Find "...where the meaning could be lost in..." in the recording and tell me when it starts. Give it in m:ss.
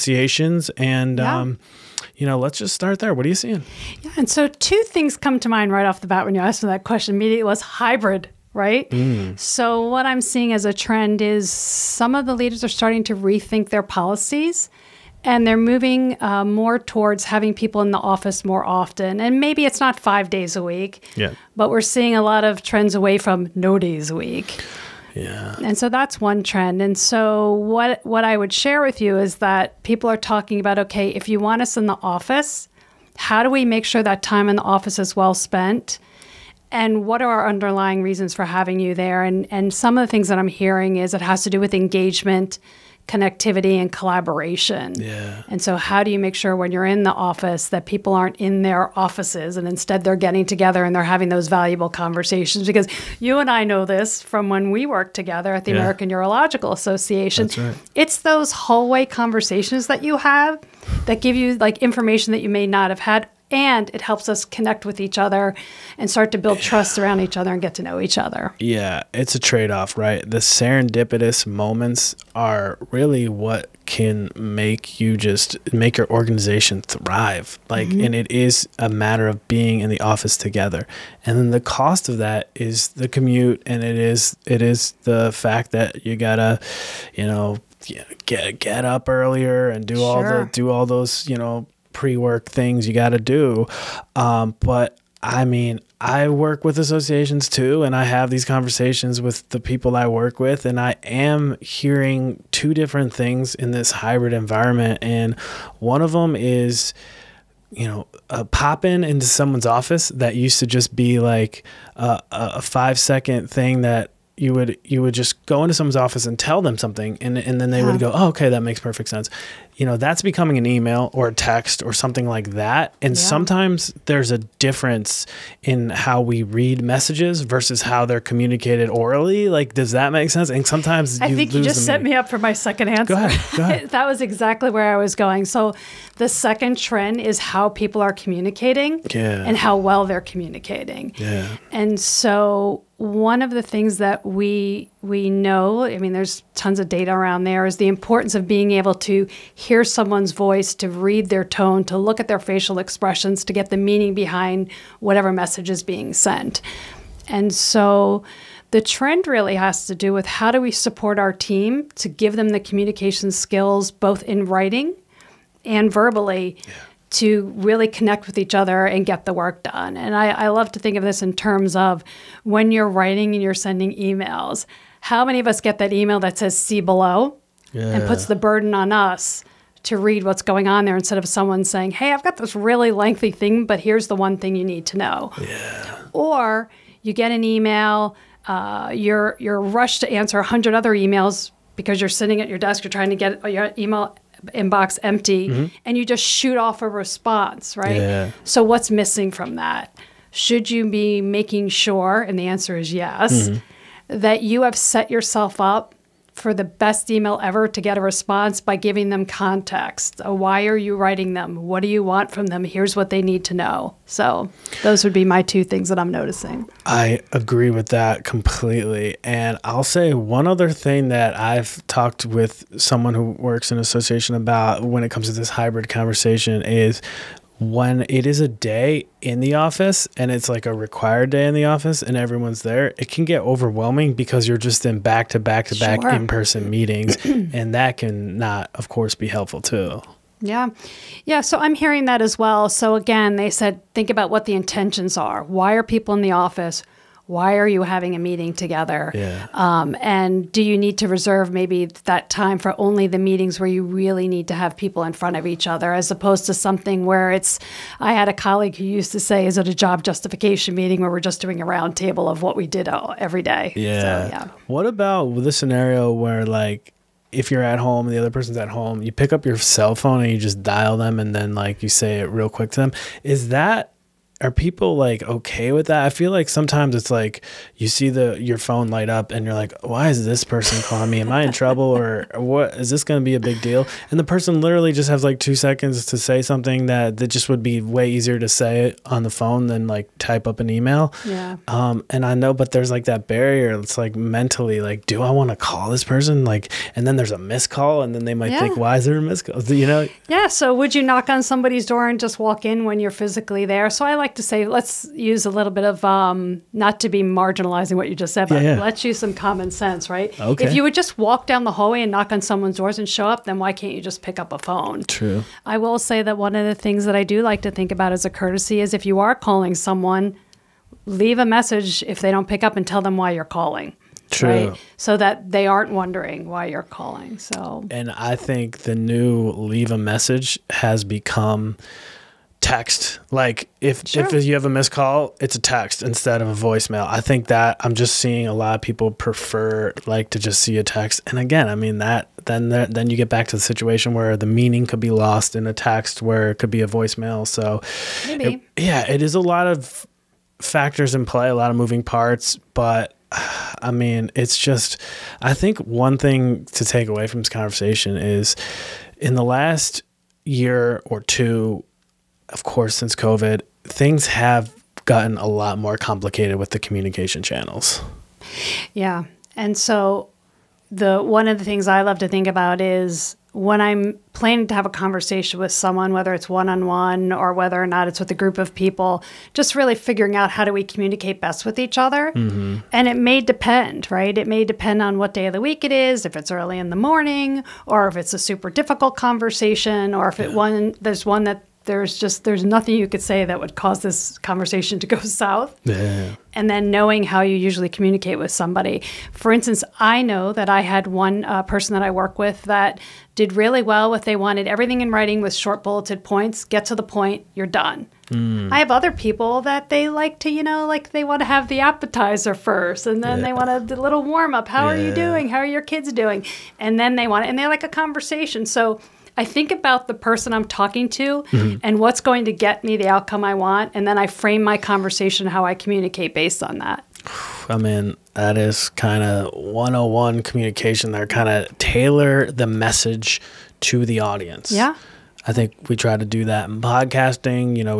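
5:44.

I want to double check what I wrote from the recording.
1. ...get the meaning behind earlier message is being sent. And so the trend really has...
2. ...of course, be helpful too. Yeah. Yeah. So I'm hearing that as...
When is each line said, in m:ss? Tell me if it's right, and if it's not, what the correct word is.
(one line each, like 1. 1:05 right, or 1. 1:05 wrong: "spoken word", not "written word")
1. 2:33 wrong: "whatever", not "earlier"
2. 3:58 right.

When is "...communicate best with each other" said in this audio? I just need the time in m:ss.
6:20.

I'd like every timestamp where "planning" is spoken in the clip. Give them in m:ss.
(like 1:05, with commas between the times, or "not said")
6:14.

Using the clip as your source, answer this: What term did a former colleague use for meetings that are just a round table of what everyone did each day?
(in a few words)
Job justification meeting.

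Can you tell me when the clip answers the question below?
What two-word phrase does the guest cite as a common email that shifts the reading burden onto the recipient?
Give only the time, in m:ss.
2:56.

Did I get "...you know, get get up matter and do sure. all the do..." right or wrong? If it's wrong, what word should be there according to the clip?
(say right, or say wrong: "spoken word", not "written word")
wrong: "earlier", not "matter".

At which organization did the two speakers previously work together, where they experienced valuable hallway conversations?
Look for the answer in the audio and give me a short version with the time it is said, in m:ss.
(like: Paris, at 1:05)
American Urological Association, at 0:55.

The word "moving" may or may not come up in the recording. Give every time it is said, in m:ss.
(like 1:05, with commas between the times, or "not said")
0:15, 5:51.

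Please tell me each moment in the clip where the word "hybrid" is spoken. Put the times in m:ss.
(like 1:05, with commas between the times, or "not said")
0:07, 1:43, 3:45.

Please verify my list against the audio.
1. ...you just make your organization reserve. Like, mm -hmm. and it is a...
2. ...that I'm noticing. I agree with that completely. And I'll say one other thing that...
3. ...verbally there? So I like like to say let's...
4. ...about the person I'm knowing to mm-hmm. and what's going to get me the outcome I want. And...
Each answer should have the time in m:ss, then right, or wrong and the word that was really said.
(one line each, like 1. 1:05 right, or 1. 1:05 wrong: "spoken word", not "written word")
1. 1:14 wrong: "thrive", not "reserve"
2. 3:35 right
3. 5:03 wrong: "physically", not "verbally"
4. 6:59 wrong: "talking", not "knowing".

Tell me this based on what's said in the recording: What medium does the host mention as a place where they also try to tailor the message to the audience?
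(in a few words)
Podcasting.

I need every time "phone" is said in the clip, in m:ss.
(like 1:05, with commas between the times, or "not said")
4:29, 4:38, 4:49, 5:14.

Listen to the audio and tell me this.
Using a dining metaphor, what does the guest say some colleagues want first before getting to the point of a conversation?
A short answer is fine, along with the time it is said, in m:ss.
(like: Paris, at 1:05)
The appetizer, at 6:51.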